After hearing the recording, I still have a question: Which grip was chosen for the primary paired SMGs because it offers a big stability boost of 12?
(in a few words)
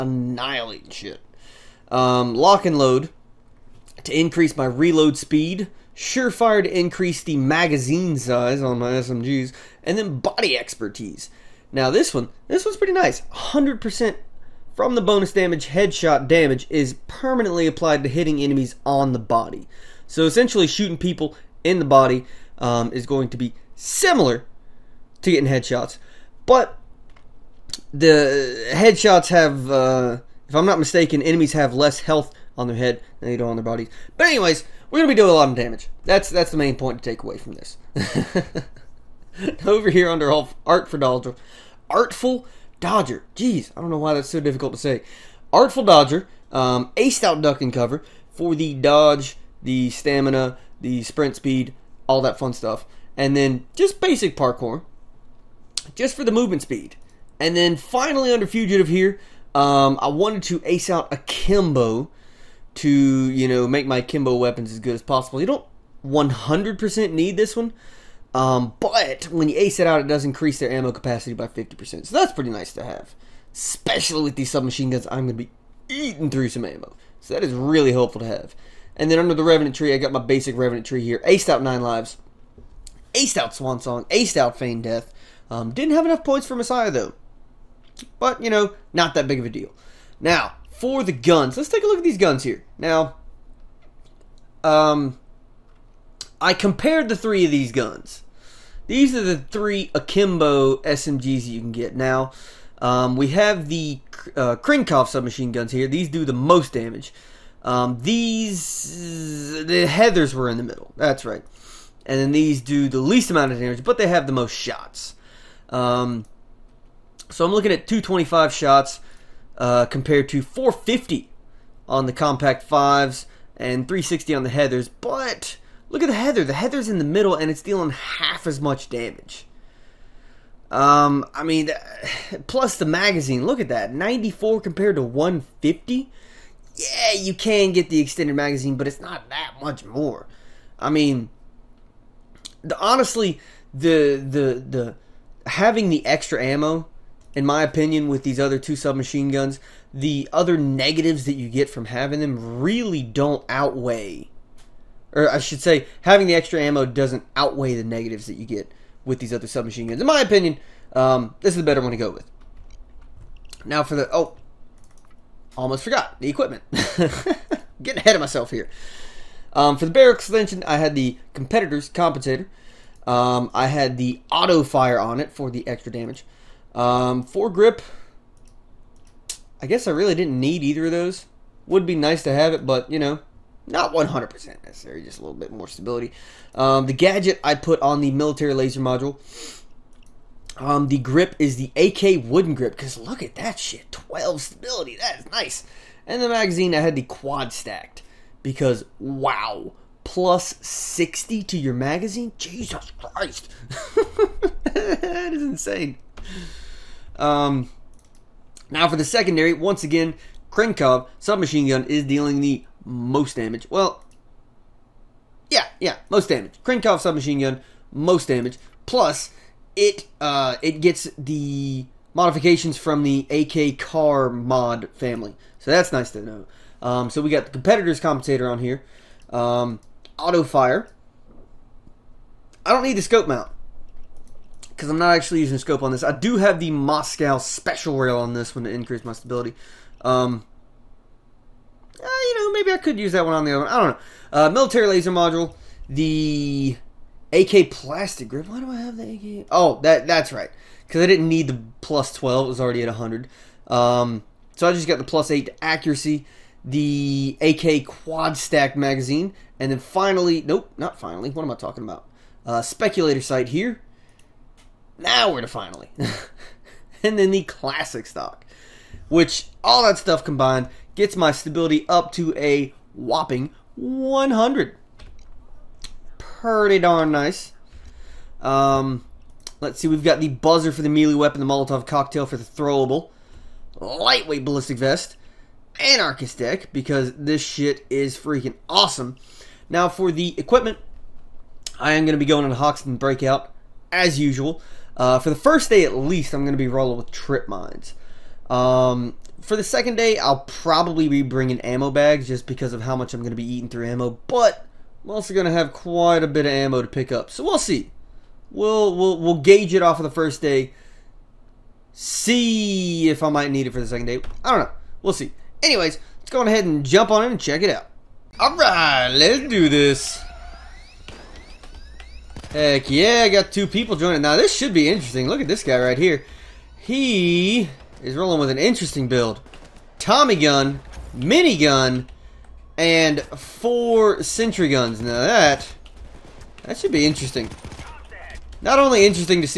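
AK wooden grip.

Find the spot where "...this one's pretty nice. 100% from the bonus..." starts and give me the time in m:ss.
0:12.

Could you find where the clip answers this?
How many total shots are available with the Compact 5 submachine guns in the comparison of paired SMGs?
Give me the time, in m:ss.
2:00.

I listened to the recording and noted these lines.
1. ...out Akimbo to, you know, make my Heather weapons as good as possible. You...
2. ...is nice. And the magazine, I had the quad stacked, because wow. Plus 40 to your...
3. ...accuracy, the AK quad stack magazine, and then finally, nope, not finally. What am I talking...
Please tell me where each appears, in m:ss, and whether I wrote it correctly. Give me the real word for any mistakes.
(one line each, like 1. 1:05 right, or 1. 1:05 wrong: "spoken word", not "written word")
1. 1:00 wrong: "Kimbo", not "Heather"
2. 3:15 wrong: "60", not "40"
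3. 4:15 right.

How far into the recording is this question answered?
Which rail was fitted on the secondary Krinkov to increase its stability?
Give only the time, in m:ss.
3:56.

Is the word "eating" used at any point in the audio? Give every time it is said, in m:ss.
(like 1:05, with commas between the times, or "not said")
1:15, 5:03.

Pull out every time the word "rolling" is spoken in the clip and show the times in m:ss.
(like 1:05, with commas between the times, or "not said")
4:56, 5:28.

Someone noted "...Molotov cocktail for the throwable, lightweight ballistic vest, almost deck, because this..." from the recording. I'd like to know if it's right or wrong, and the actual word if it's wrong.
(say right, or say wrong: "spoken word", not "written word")
wrong: "anarchist", not "almost".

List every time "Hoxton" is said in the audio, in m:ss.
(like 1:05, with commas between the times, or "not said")
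4:52.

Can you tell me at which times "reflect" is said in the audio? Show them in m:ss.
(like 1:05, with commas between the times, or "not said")
not said.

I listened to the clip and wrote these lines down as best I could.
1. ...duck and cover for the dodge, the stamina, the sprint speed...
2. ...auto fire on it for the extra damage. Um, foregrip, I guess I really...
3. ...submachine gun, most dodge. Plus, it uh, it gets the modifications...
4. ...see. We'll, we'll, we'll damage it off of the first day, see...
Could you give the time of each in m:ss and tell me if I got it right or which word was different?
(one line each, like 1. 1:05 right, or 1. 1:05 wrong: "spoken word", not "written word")
1. 0:47 right
2. 2:54 right
3. 3:37 wrong: "damage", not "dodge"
4. 5:07 wrong: "gauge", not "damage".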